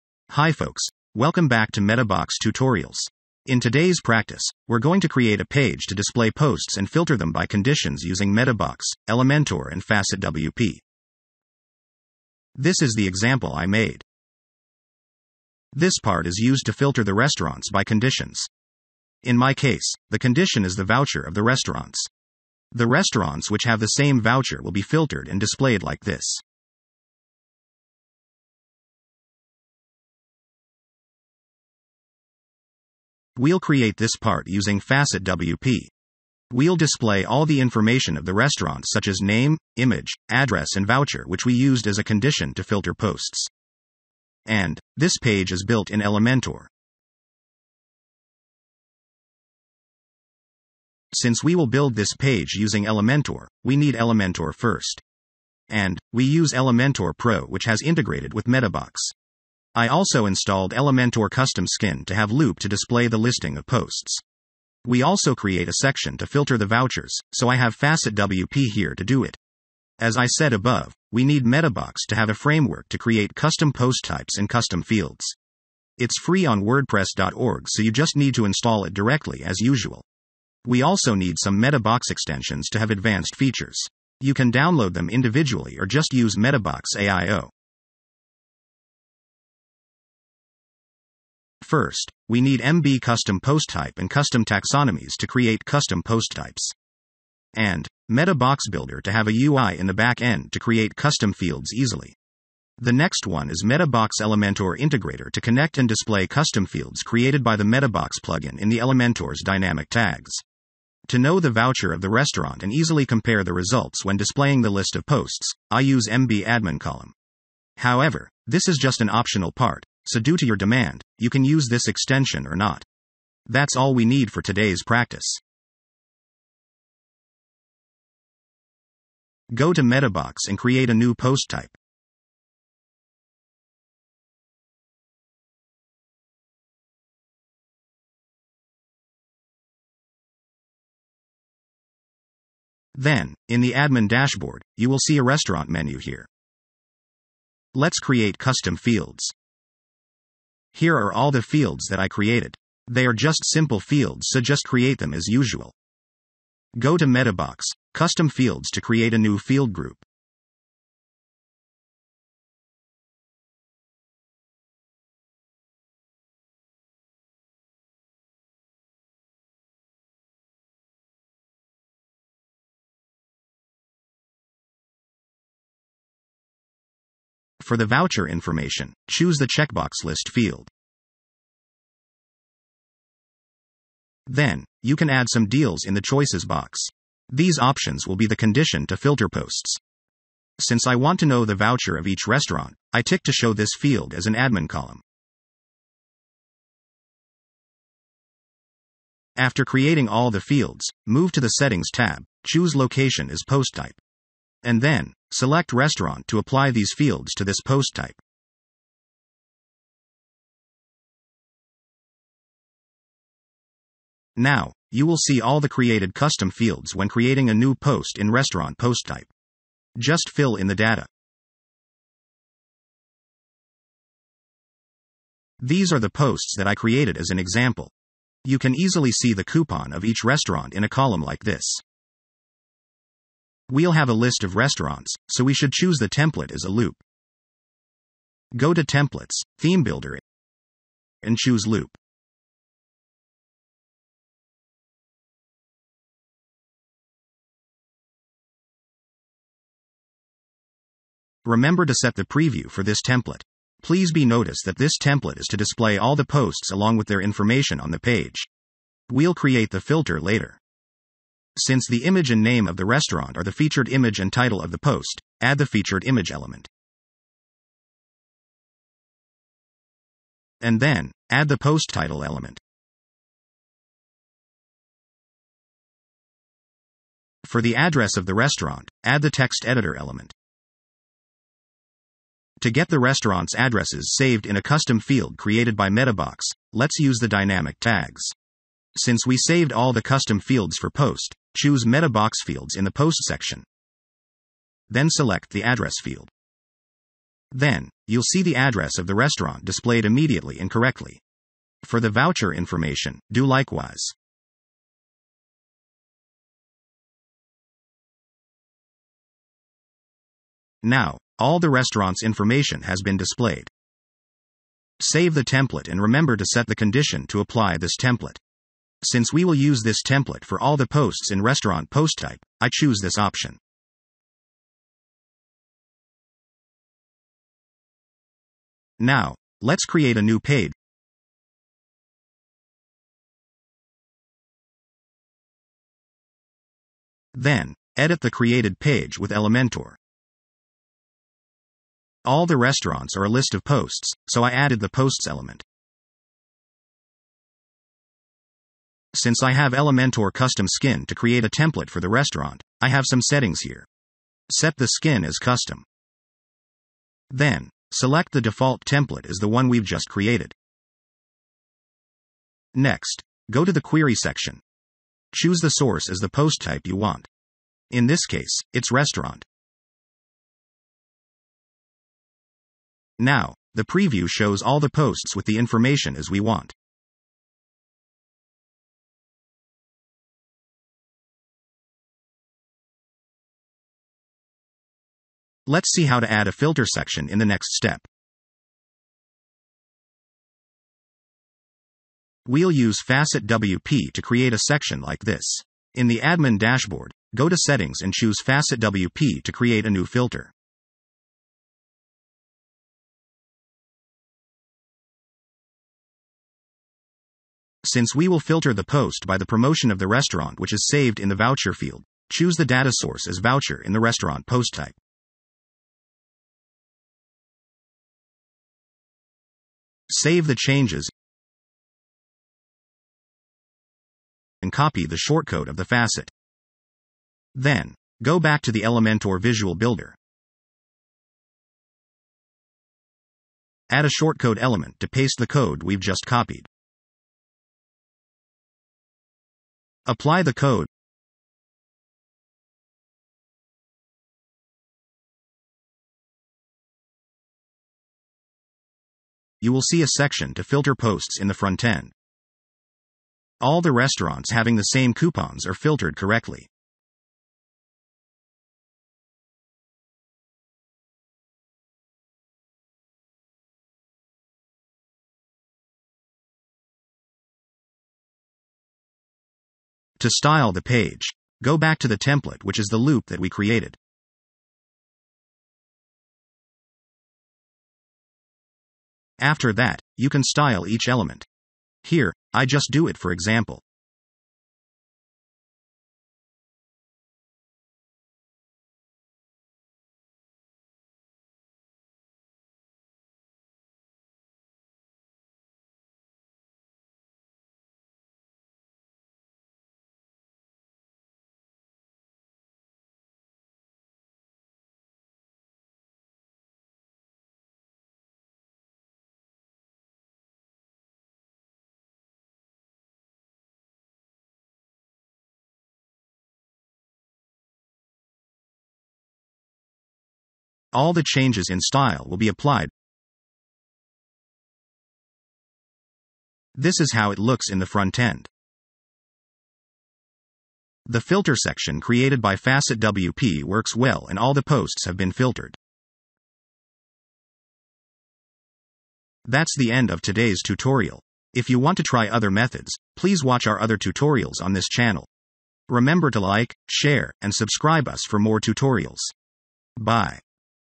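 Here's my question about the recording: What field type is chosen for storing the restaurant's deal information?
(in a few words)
Checkbox list.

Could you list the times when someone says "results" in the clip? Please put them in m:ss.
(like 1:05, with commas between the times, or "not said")
1:53.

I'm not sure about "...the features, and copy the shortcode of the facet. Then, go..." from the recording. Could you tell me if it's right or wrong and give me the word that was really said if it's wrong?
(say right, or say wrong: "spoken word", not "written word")
wrong: "changes", not "features".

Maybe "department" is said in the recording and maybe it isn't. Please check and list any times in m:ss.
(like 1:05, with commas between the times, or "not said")
not said.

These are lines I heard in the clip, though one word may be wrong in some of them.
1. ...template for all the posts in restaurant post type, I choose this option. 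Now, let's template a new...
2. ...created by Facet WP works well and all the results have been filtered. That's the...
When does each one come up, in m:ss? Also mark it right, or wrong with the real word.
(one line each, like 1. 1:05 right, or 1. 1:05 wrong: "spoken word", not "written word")
1. 5:20 wrong: "create", not "template"
2. 8:52 wrong: "posts", not "results".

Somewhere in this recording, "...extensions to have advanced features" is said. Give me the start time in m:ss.
1:22.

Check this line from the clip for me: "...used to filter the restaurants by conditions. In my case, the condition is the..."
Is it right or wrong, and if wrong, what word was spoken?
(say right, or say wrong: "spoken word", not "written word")
right.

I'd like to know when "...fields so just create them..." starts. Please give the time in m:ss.
2:33.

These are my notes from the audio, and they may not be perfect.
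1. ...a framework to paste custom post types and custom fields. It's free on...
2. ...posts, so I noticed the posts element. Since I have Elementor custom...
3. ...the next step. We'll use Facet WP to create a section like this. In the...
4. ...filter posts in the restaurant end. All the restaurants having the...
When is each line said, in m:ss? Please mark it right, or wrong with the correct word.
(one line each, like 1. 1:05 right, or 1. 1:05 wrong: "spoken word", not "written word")
1. 1:12 wrong: "create", not "paste"
2. 5:43 wrong: "added", not "noticed"
3. 6:27 right
4. 7:30 wrong: "front", not "restaurant".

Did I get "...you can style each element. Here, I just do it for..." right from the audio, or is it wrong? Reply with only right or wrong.
right.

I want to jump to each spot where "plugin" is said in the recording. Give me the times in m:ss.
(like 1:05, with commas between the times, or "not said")
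1:48.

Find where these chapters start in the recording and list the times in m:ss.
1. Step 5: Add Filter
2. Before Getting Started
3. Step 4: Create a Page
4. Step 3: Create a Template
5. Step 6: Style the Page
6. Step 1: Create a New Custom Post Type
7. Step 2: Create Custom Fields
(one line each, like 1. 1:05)
1. 6:30
2. 0:49
3. 5:26
4. 3:55
5. 7:47
6. 2:06
7. 2:27.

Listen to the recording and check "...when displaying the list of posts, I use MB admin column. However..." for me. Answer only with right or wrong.
right.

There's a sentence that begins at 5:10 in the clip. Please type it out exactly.
Now, all the restaurant's information has been displayed.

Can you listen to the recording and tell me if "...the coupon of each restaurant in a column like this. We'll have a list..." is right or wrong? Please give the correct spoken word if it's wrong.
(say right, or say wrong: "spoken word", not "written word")
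right.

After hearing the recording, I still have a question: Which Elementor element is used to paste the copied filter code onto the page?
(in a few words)
Shortcode element.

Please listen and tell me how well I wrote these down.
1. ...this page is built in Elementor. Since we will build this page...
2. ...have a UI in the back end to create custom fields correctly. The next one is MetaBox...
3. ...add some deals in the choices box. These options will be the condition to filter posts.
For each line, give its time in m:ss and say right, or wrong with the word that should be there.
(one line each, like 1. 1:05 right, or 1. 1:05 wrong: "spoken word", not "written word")
1. 0:44 right
2. 1:39 wrong: "easily", not "correctly"
3. 3:05 right.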